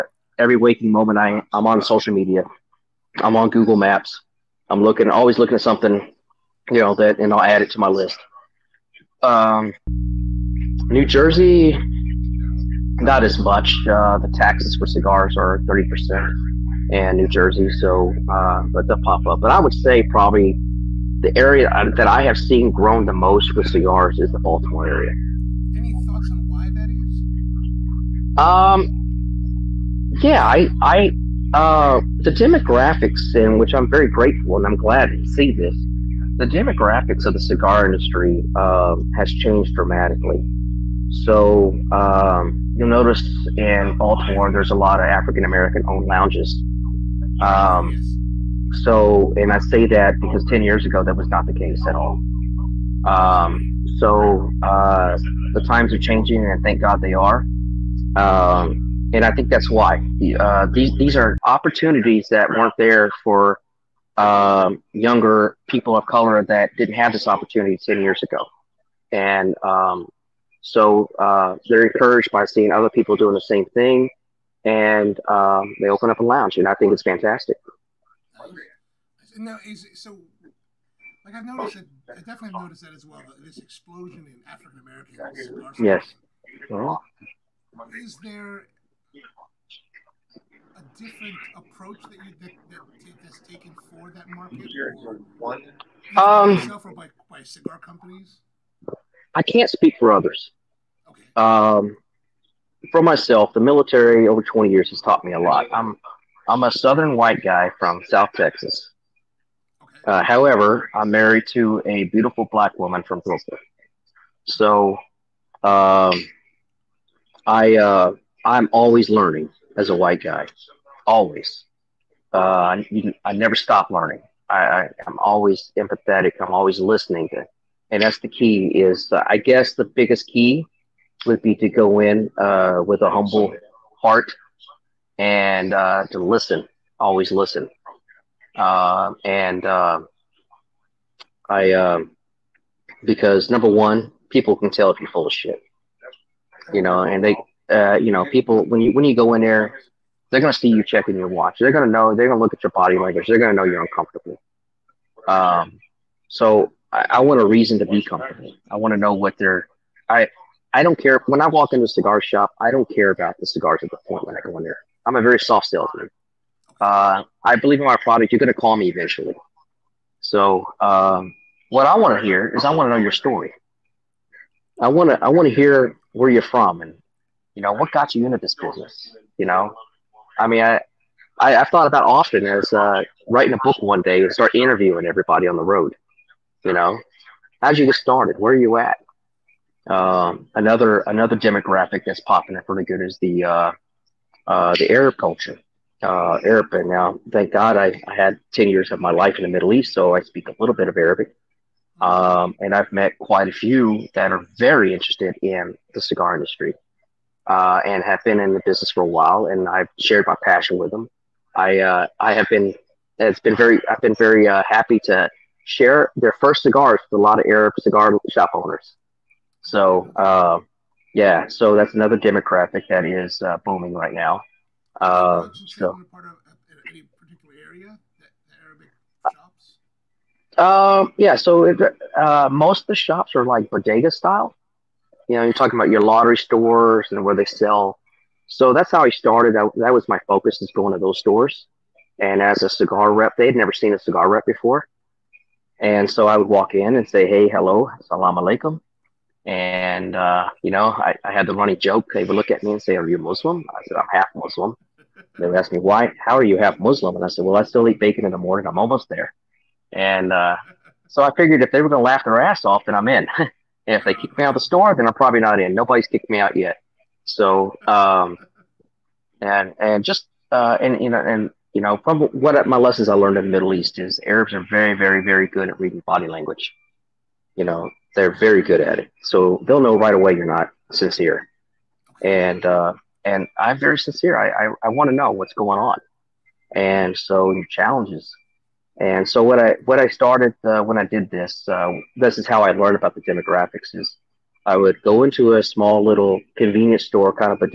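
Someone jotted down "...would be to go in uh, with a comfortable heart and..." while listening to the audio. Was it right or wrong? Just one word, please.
wrong.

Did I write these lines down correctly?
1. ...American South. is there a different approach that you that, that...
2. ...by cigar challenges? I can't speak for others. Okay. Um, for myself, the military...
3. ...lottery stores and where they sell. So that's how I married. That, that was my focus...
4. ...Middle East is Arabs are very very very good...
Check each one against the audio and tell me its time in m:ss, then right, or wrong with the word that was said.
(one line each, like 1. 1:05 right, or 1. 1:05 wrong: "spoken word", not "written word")
1. 1:24 wrong: "Yes", not "South"
2. 1:37 wrong: "companies", not "challenges"
3. 3:56 wrong: "started", not "married"
4. 4:33 right.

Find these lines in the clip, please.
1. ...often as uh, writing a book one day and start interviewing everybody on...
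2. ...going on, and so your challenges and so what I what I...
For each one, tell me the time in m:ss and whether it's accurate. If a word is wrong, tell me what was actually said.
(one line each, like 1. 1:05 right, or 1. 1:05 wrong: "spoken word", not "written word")
1. 3:02 right
2. 4:45 right.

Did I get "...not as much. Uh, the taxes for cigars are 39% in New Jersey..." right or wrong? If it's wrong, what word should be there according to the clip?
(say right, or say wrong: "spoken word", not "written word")
wrong: "30", not "39".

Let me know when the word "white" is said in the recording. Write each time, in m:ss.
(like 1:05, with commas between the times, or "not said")
1:47, 1:59.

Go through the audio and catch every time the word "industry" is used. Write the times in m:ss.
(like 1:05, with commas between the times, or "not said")
0:37, 3:26.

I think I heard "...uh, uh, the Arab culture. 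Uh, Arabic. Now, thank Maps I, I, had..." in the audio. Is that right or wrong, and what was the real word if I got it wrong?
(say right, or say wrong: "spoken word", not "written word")
wrong: "God", not "Maps".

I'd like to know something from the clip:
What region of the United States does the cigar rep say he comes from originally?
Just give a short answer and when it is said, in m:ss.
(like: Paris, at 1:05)
South Texas, at 1:48.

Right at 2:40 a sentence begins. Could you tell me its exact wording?
I I don't care when I walk into a cigar shop.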